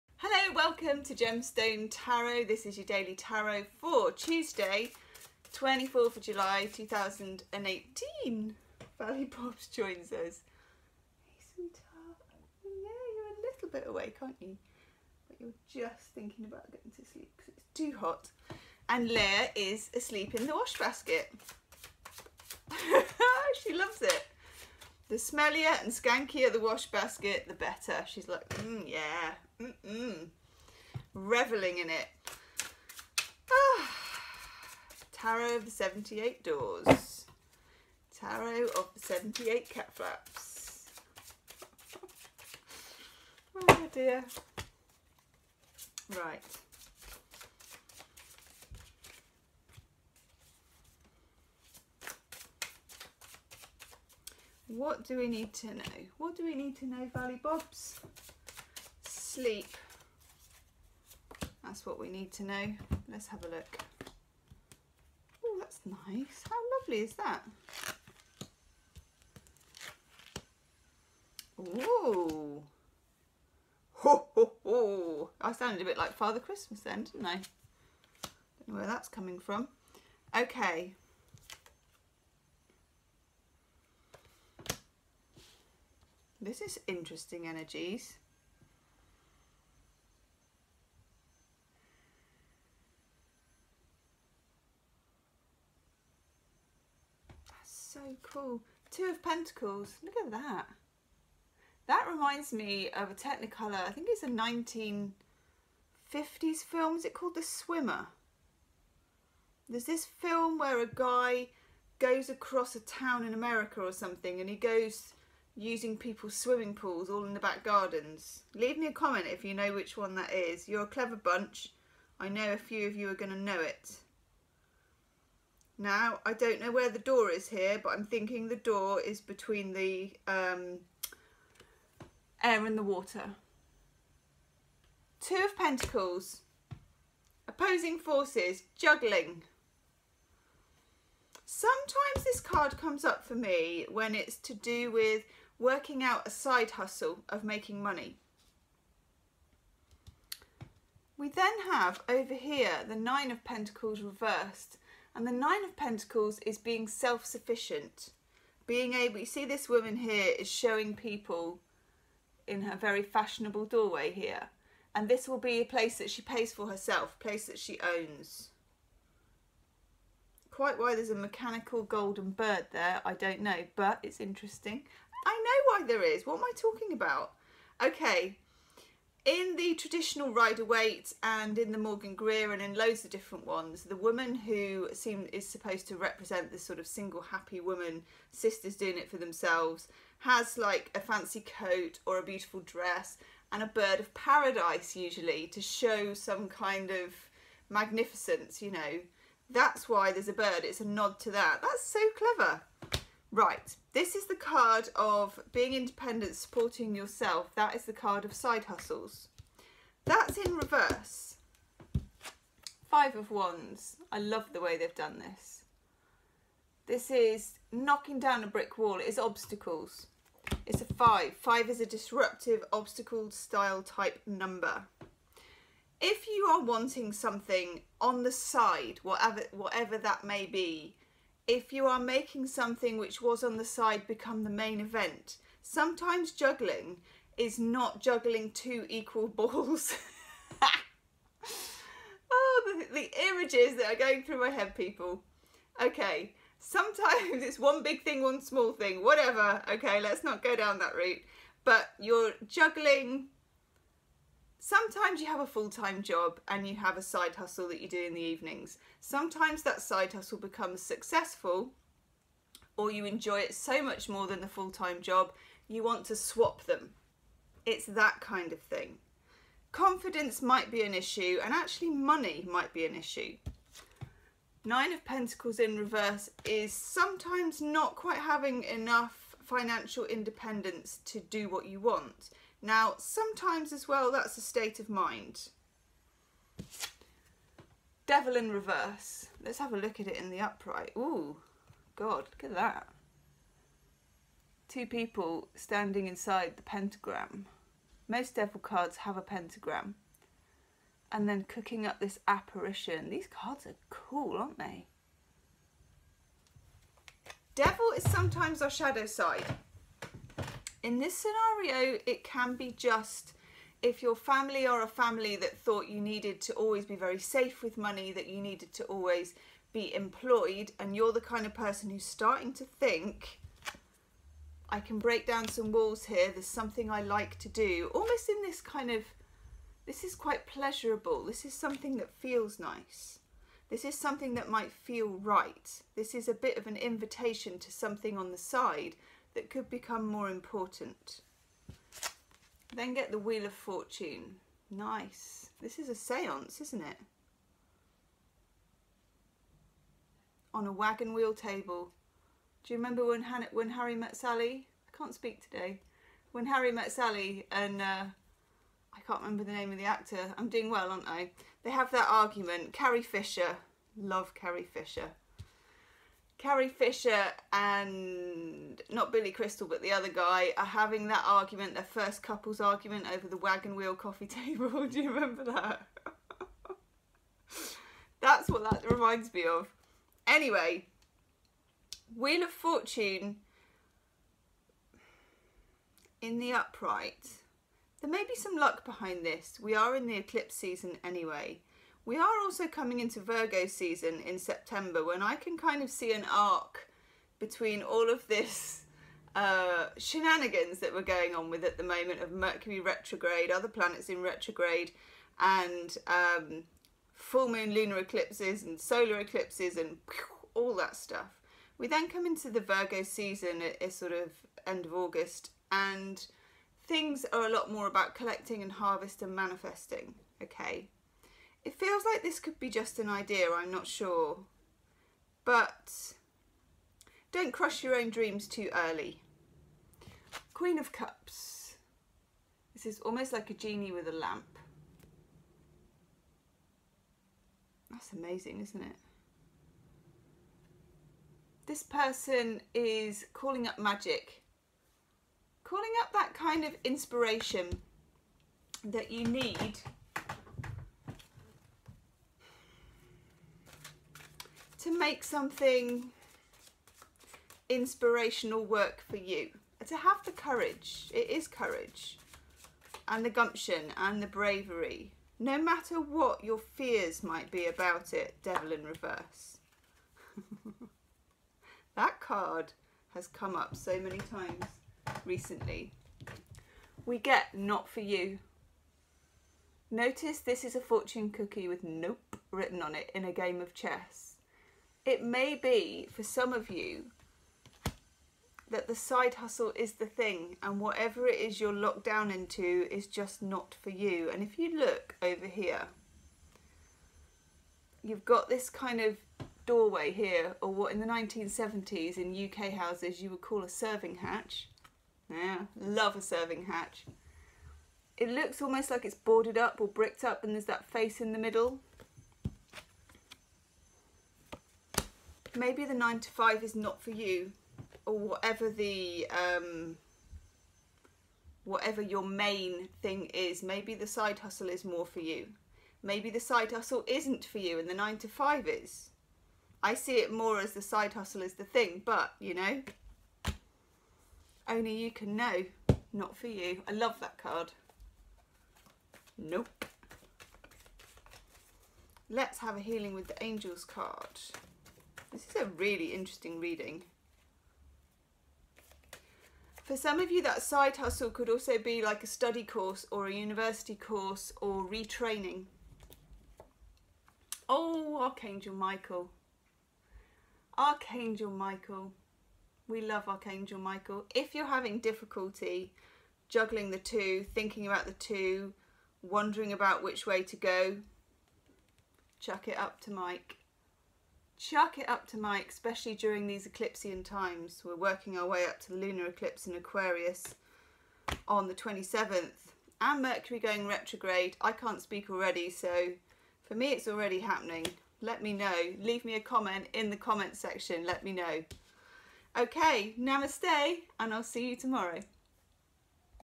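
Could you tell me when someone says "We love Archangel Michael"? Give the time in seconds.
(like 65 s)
562 s.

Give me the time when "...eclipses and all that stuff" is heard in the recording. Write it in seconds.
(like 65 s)
409 s.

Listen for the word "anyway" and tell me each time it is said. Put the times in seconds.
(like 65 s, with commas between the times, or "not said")
380 s, 391 s.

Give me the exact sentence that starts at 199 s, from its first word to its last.
That's why there's a bird, it's a nod to that.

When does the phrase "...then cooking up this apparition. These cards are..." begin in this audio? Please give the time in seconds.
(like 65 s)
301 s.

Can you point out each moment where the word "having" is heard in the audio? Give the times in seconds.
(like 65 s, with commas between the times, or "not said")
278 s, 370 s, 564 s.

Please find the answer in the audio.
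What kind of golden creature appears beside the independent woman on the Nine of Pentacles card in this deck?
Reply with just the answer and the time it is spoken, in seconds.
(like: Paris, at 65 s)
A mechanical golden bird, at 171 s.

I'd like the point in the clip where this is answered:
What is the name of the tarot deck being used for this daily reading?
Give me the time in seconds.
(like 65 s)
35 s.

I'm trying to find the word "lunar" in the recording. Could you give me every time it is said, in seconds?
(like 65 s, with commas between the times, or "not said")
407 s, 578 s.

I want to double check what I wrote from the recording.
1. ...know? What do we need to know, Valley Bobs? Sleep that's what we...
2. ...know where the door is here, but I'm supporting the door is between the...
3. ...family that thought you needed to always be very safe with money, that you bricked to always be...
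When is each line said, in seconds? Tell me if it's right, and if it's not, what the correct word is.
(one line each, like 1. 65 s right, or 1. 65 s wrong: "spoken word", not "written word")
1. 55 s right
2. 126 s wrong: "thinking", not "supporting"
3. 314 s wrong: "needed", not "bricked".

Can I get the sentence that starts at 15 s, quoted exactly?
But you're just thinking about getting to sleep because it's too hot.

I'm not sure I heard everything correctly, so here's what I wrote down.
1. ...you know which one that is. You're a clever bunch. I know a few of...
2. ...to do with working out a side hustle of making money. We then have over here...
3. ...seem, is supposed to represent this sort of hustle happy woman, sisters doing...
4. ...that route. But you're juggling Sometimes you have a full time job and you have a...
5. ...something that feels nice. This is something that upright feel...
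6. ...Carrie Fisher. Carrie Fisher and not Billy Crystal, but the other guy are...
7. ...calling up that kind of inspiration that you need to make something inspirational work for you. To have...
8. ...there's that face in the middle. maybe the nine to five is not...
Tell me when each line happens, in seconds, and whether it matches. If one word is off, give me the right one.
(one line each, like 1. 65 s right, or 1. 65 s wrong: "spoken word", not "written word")
1. 119 s right
2. 144 s right
3. 184 s wrong: "single", not "hustle"
4. 250 s right
5. 331 s wrong: "might", not "upright"
6. 364 s right
7. 445 s right
8. 510 s right.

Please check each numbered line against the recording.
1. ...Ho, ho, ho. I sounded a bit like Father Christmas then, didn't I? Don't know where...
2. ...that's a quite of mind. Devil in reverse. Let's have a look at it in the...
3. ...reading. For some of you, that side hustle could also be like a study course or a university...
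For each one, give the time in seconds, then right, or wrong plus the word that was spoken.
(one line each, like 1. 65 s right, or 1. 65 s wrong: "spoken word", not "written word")
1. 73 s right
2. 284 s wrong: "state", not "quite"
3. 546 s right.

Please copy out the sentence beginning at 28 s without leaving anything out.
She's like, mm, yeah, mm-mm reveling in it.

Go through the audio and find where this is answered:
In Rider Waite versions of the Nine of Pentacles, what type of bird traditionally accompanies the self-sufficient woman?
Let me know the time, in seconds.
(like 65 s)
193 s.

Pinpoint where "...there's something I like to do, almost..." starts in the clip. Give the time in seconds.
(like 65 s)
326 s.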